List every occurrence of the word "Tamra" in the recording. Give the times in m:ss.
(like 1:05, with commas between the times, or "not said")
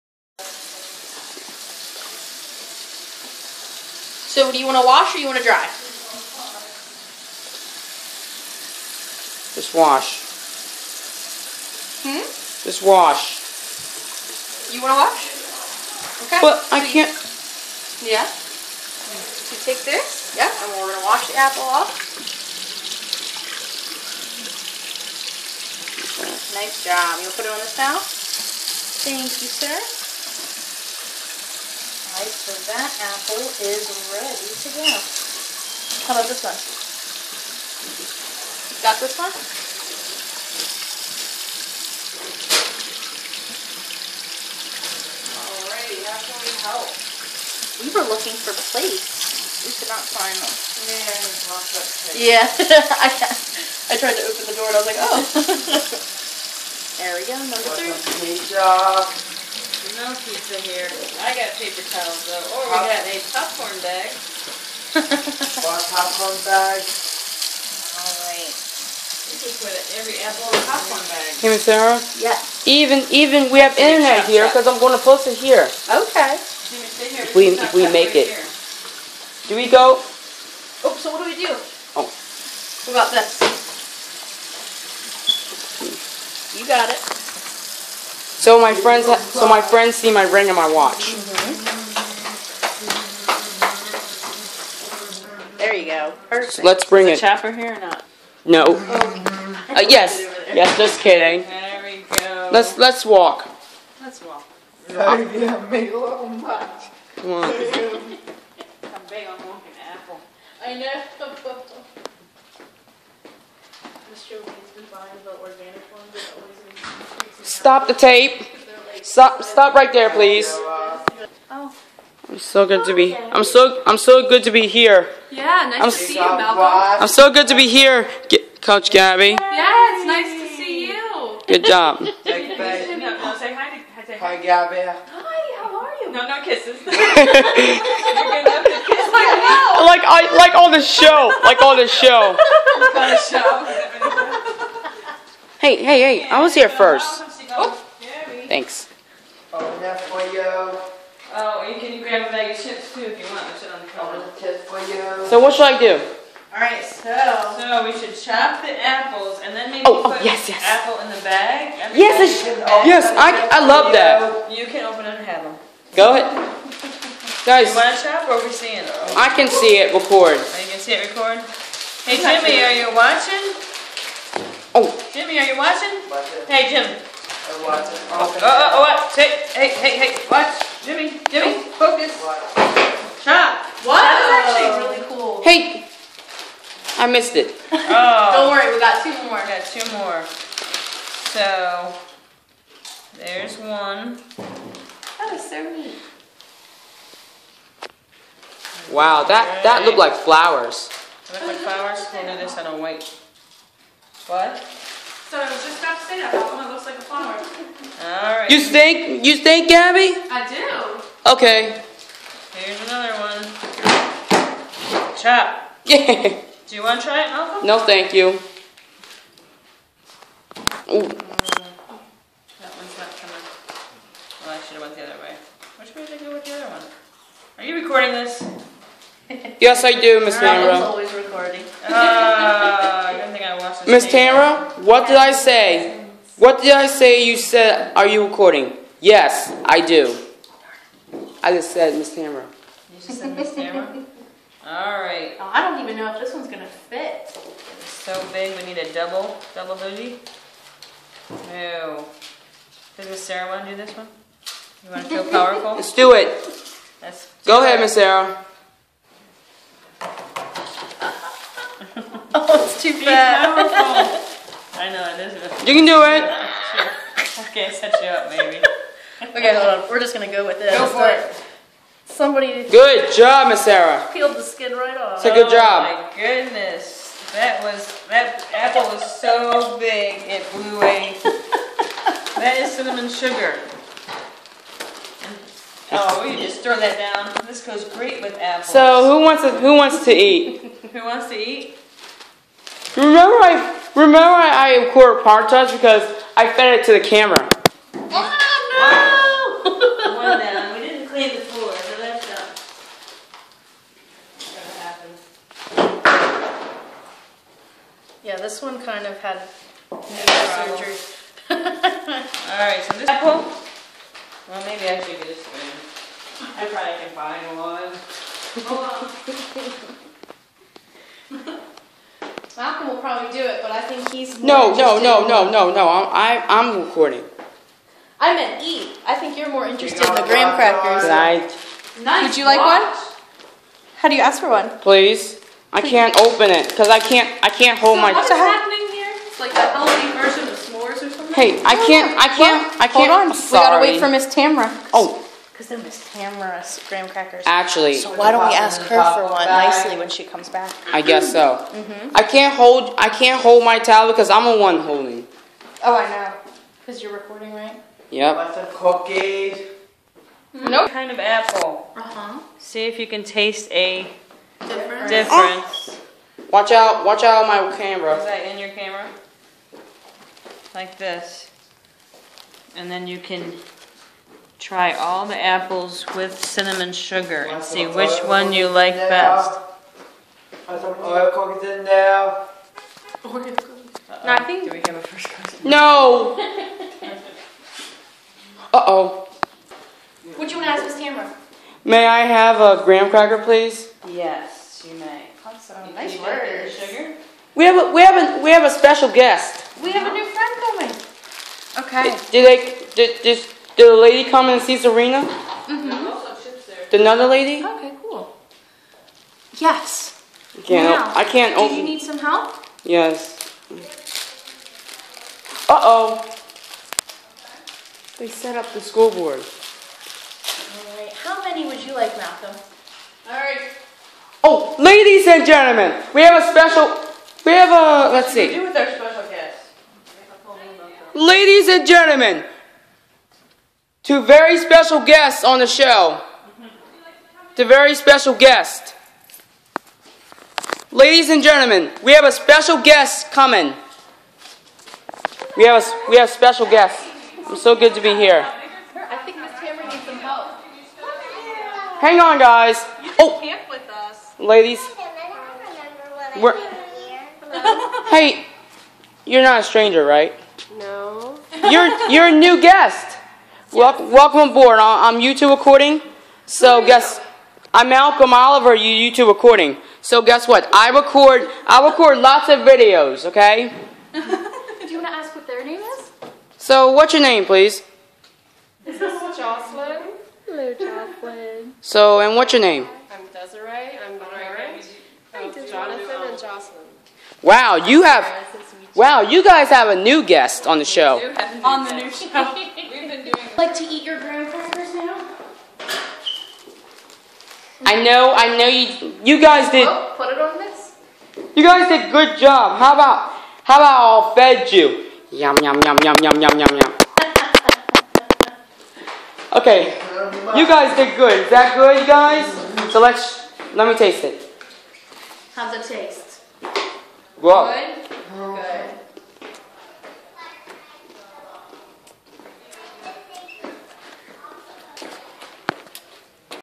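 3:54, 5:44.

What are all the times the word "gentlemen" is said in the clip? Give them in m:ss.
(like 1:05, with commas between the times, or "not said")
7:05, 7:11, 7:21.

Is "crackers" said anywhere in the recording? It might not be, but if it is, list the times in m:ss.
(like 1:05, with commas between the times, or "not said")
5:30, 5:47, 6:33.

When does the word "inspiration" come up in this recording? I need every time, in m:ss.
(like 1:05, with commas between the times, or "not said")
not said.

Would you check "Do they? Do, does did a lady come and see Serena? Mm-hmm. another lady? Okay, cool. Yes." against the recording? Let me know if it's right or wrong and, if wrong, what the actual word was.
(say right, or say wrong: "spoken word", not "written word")
right.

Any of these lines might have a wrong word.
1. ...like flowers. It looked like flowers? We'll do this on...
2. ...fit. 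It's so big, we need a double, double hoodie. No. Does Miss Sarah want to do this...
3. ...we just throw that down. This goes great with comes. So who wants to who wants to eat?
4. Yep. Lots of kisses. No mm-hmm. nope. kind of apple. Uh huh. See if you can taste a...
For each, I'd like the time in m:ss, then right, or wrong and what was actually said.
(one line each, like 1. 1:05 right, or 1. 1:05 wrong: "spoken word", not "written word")
1. 3:19 right
2. 4:06 right
3. 4:46 wrong: "apples", not "comes"
4. 5:58 wrong: "cookies", not "kisses".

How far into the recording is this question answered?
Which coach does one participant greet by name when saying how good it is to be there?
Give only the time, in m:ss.
2:08.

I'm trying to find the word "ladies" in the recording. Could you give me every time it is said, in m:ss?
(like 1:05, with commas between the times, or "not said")
7:04, 7:11, 7:20, 7:34.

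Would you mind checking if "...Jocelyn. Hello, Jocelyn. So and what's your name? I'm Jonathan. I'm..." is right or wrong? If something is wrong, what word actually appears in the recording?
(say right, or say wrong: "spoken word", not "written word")
wrong: "Desiree", not "Jonathan".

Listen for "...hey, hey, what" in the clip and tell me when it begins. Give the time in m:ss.
2:59.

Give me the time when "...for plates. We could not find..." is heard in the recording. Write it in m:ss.
0:48.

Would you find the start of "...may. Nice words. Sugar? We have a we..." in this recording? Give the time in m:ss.
6:34.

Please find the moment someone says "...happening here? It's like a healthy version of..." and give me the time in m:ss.
5:38.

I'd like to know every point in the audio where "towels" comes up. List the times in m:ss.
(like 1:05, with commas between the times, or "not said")
1:01, 5:53.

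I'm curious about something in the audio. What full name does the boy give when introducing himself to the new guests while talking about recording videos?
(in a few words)
Malcolm Oliver.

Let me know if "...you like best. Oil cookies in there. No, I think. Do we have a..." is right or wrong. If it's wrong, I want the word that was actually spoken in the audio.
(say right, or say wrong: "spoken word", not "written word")
right.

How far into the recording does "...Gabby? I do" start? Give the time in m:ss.
3:29.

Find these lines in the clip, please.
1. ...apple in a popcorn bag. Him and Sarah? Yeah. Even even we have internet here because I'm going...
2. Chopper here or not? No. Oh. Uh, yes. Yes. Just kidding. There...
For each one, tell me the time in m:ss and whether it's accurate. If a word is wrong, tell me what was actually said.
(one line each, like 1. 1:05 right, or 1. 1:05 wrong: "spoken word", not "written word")
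1. 1:10 right
2. 1:37 right.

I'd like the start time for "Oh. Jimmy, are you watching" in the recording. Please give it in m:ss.
2:54.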